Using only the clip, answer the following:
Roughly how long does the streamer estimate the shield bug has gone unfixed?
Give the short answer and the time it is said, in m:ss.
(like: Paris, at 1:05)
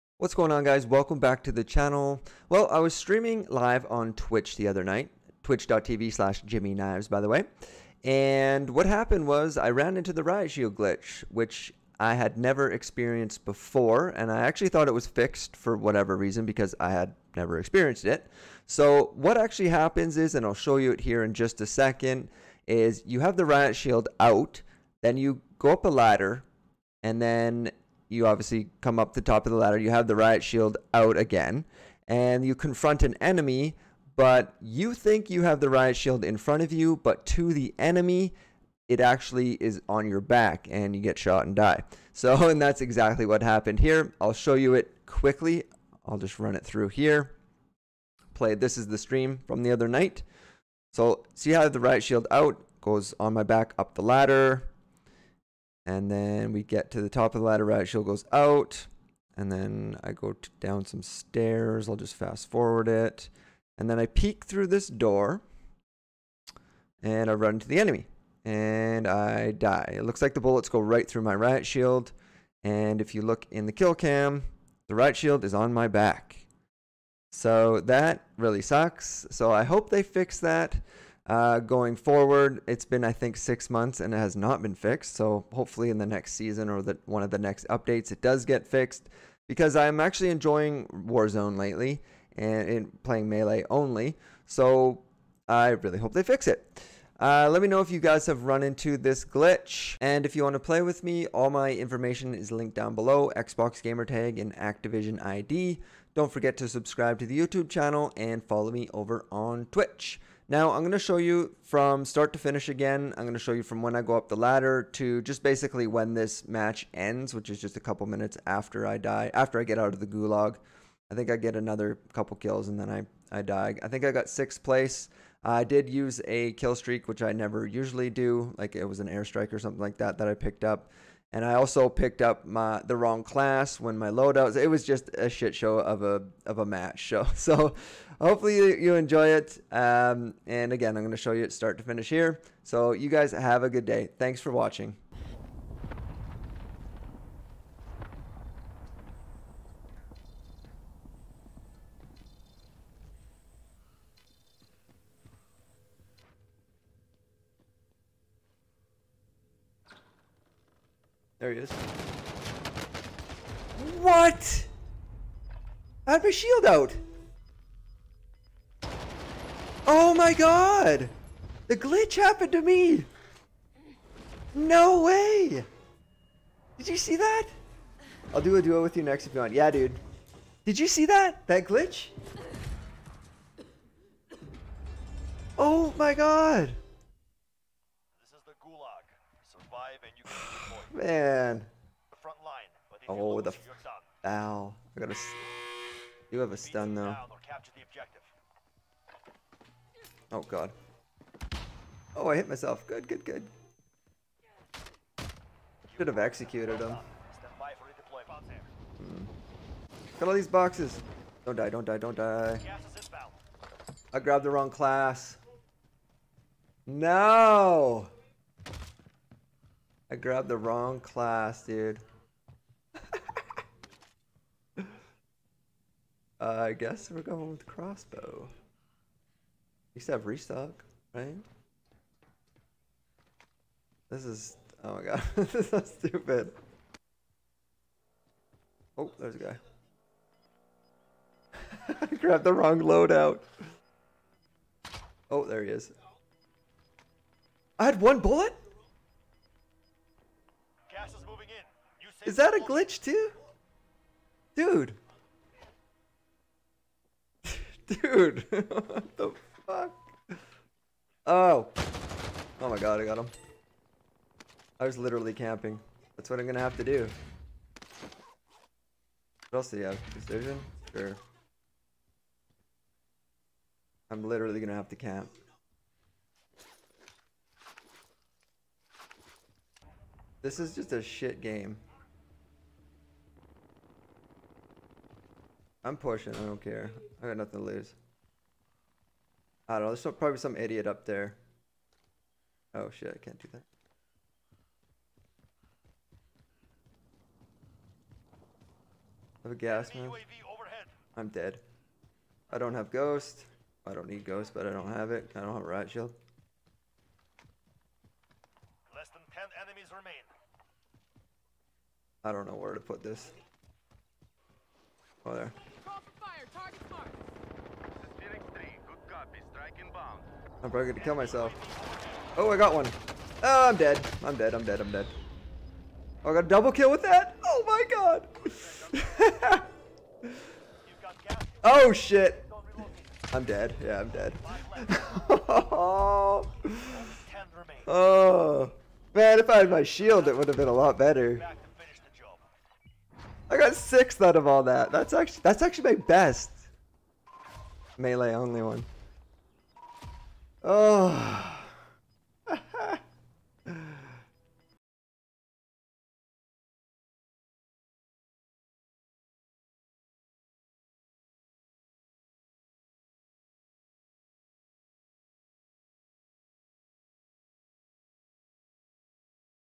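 6 months, at 1:23.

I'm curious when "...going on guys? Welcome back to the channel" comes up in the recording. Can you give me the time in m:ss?
0:00.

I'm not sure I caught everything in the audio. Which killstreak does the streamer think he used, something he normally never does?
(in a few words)
Airstrike.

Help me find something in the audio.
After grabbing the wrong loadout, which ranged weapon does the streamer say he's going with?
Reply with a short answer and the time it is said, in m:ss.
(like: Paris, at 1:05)
Crossbow, at 3:47.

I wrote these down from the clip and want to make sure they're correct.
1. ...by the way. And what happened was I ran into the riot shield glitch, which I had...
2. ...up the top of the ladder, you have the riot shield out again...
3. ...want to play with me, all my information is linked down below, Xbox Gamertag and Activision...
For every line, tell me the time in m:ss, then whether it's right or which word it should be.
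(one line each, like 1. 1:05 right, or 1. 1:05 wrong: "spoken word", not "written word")
1. 0:07 right
2. 0:28 right
3. 1:40 right.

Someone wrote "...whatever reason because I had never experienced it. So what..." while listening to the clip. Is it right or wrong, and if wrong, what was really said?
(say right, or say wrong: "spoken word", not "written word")
right.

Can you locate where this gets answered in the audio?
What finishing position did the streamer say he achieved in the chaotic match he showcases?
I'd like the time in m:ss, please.
2:04.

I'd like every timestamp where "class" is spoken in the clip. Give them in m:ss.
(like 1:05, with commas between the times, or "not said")
2:13, 3:34, 3:41.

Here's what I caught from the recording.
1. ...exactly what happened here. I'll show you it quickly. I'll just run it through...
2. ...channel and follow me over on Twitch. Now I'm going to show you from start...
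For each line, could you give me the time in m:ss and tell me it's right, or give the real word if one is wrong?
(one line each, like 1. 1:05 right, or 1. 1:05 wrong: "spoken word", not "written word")
1. 0:42 right
2. 1:47 right.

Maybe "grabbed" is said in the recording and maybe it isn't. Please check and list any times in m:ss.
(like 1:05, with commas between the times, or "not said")
3:34, 3:40, 4:02.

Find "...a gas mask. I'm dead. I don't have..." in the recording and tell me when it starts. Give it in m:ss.
4:59.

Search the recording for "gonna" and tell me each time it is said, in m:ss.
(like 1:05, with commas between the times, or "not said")
4:26, 4:34, 5:20.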